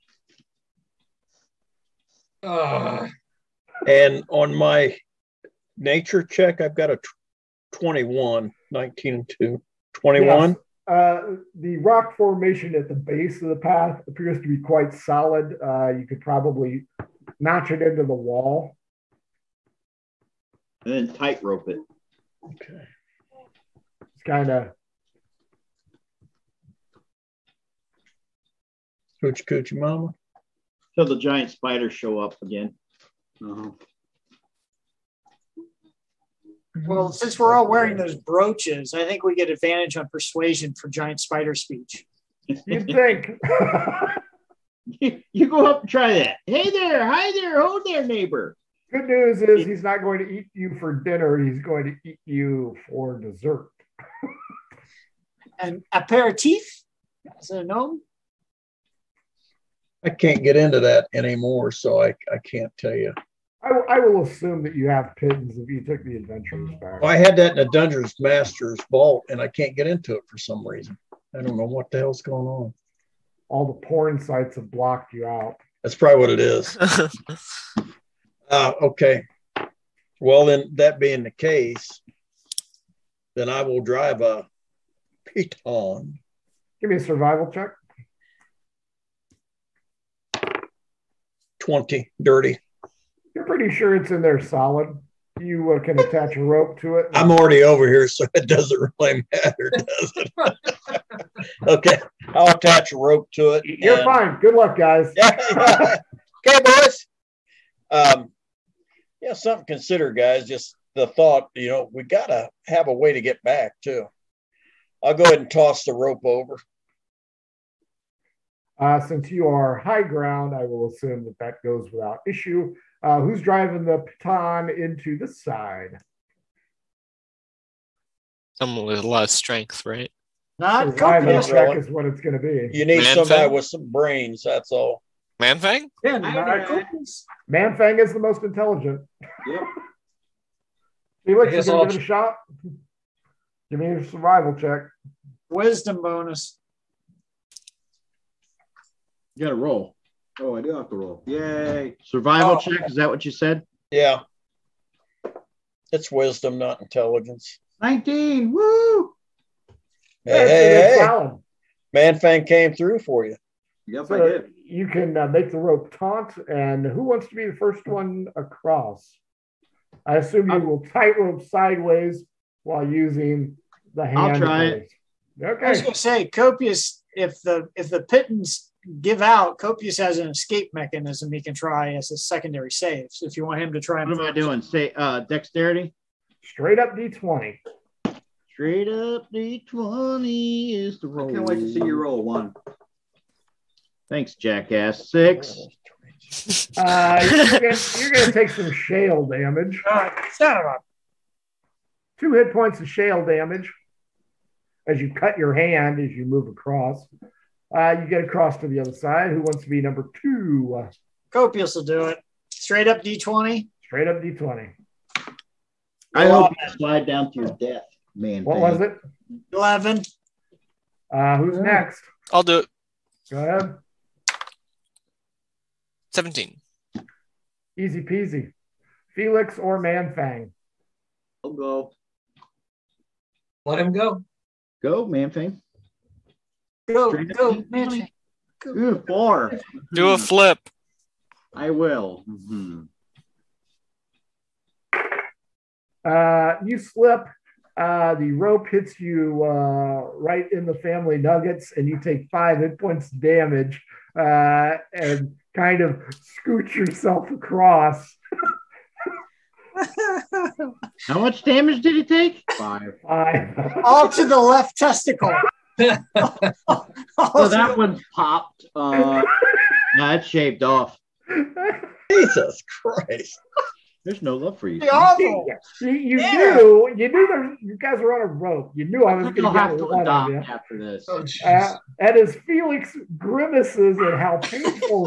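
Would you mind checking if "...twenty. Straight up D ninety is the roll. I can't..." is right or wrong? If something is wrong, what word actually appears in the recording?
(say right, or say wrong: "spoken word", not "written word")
wrong: "twenty", not "ninety".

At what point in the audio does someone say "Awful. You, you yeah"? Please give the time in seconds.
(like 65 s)
274 s.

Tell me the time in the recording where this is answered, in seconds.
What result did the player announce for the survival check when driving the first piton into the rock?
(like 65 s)
91 s.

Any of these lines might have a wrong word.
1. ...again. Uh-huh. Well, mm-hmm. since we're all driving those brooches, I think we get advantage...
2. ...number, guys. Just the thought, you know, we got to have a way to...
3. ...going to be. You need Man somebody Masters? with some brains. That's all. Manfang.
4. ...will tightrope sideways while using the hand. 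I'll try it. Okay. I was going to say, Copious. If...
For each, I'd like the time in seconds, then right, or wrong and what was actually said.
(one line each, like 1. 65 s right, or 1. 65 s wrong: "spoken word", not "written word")
1. 32 s wrong: "wearing", not "driving"
2. 109 s wrong: "consider", not "number"
3. 132 s wrong: "Fang", not "Masters"
4. 170 s right.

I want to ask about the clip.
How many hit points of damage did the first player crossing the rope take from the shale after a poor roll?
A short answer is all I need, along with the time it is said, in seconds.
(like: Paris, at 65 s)
2, at 202 s.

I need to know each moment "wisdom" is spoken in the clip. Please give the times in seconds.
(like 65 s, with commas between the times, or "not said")
145 s, 156 s.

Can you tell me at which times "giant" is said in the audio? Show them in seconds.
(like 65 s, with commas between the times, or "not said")
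31 s, 40 s.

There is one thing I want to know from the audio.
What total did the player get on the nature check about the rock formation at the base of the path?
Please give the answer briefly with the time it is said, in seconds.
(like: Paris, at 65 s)
21, at 6 s.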